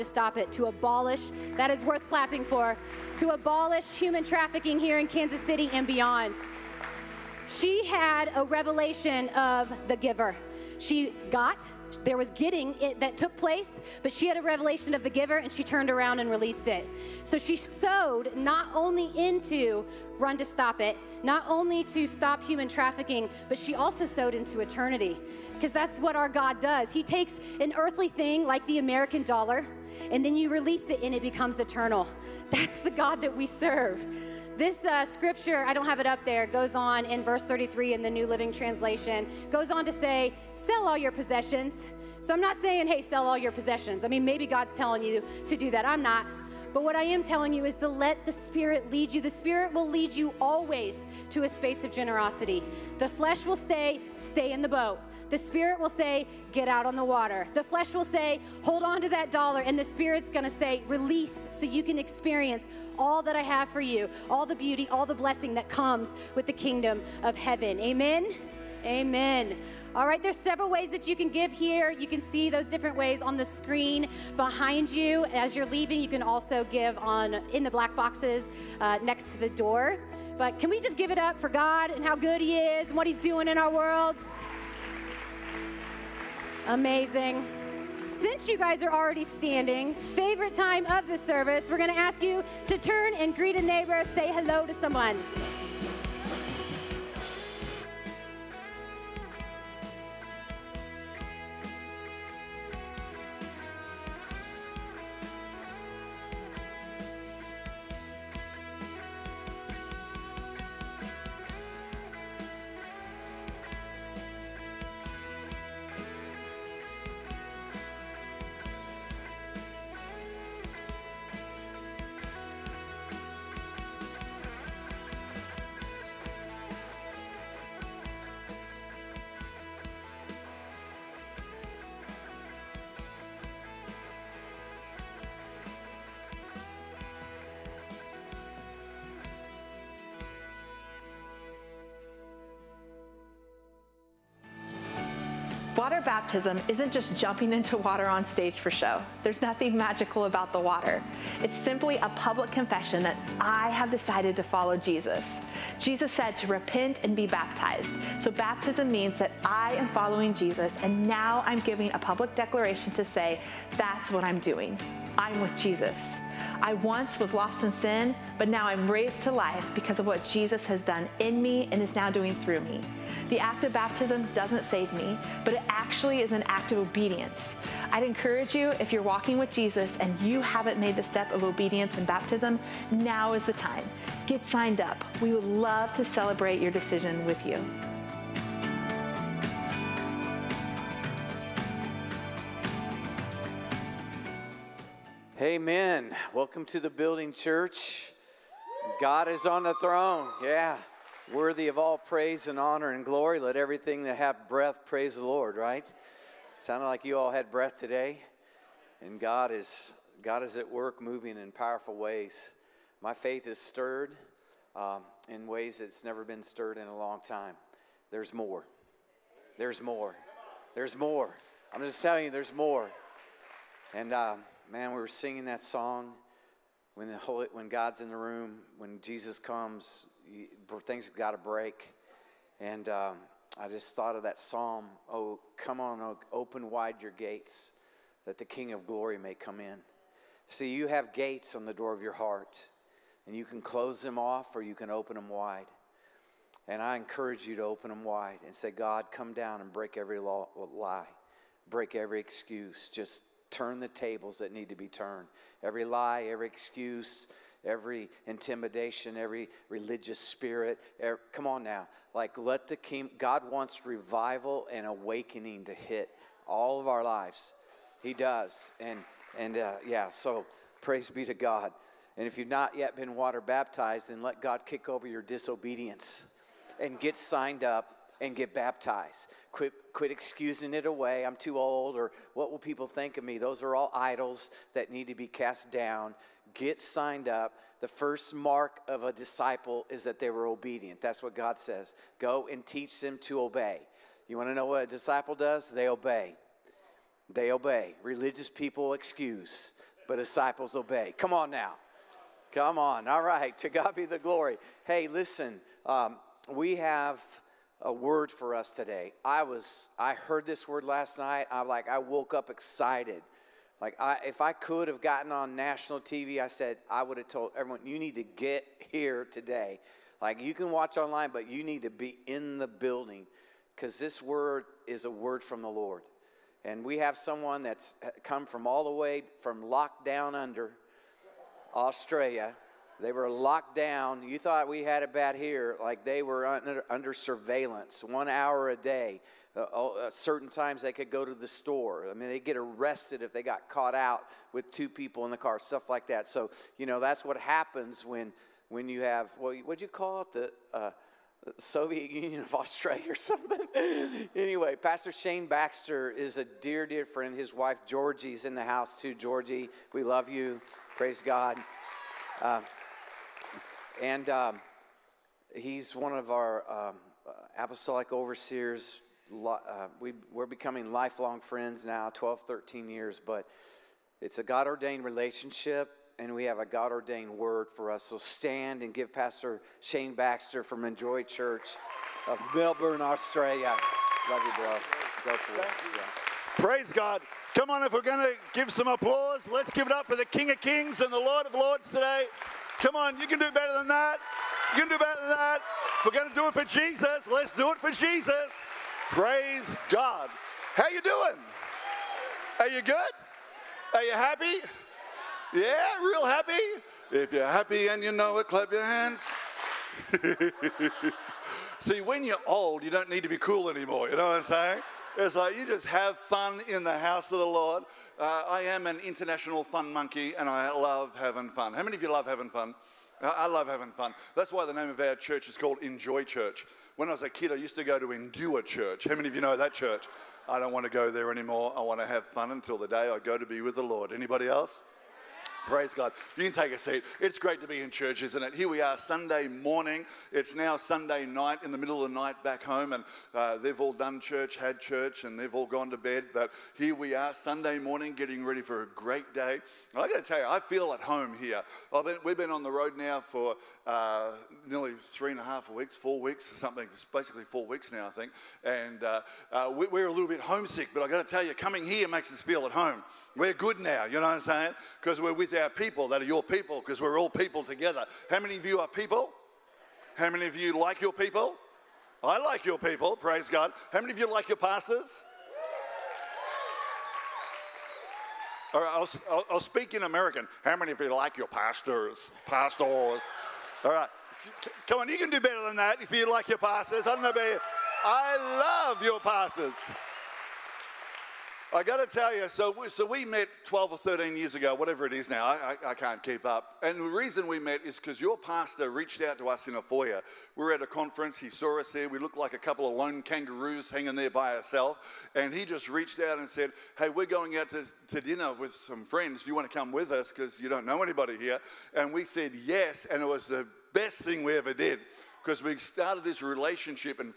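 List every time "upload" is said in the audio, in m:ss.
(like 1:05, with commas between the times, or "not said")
not said.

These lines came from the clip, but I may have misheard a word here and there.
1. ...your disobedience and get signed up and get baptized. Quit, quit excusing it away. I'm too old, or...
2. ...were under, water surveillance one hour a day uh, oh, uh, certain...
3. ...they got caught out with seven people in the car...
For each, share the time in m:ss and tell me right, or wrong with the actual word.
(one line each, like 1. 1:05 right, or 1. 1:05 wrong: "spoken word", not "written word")
1. 4:35 right
2. 5:36 wrong: "under", not "water"
3. 5:43 wrong: "two", not "seven".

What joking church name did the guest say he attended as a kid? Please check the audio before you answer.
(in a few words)
Endure Church.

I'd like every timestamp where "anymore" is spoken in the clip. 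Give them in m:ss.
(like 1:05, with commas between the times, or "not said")
6:53, 7:11.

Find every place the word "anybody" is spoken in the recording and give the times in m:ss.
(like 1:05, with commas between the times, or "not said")
7:14, 8:31.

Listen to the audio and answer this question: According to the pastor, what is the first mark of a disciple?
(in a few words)
obedient.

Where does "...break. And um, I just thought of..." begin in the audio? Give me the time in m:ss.
3:51.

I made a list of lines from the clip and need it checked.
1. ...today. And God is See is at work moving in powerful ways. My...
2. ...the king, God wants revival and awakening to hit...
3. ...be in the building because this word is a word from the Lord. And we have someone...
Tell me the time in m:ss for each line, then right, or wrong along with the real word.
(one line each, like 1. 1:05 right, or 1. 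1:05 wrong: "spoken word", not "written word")
1. 3:27 wrong: "God", not "See"
2. 4:22 right
3. 5:21 right.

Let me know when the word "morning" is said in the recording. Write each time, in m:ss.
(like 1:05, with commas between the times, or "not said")
7:19, 7:27.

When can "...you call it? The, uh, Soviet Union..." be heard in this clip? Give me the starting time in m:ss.
5:49.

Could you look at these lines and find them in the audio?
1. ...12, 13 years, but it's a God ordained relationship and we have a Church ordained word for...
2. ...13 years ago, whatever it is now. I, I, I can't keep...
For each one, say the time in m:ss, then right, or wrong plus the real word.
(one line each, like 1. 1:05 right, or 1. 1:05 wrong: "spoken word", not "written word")
1. 6:12 wrong: "God", not "Church"
2. 8:13 right.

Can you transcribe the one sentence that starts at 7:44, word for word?
Because we're with our people that are your people, because we're all people together.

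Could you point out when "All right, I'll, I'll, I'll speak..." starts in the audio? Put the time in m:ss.
7:58.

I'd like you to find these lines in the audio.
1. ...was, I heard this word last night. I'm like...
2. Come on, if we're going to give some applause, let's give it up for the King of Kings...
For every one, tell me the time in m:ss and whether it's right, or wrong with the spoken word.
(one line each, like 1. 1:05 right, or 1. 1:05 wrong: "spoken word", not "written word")
1. 5:09 right
2. 6:27 right.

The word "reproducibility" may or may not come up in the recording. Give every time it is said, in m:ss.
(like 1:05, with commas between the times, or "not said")
not said.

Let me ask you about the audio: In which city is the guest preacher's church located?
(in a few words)
Melbourne.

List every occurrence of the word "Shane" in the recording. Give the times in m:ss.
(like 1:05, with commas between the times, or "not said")
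5:55, 6:19.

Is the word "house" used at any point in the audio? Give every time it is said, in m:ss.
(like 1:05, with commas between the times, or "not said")
5:58, 6:56.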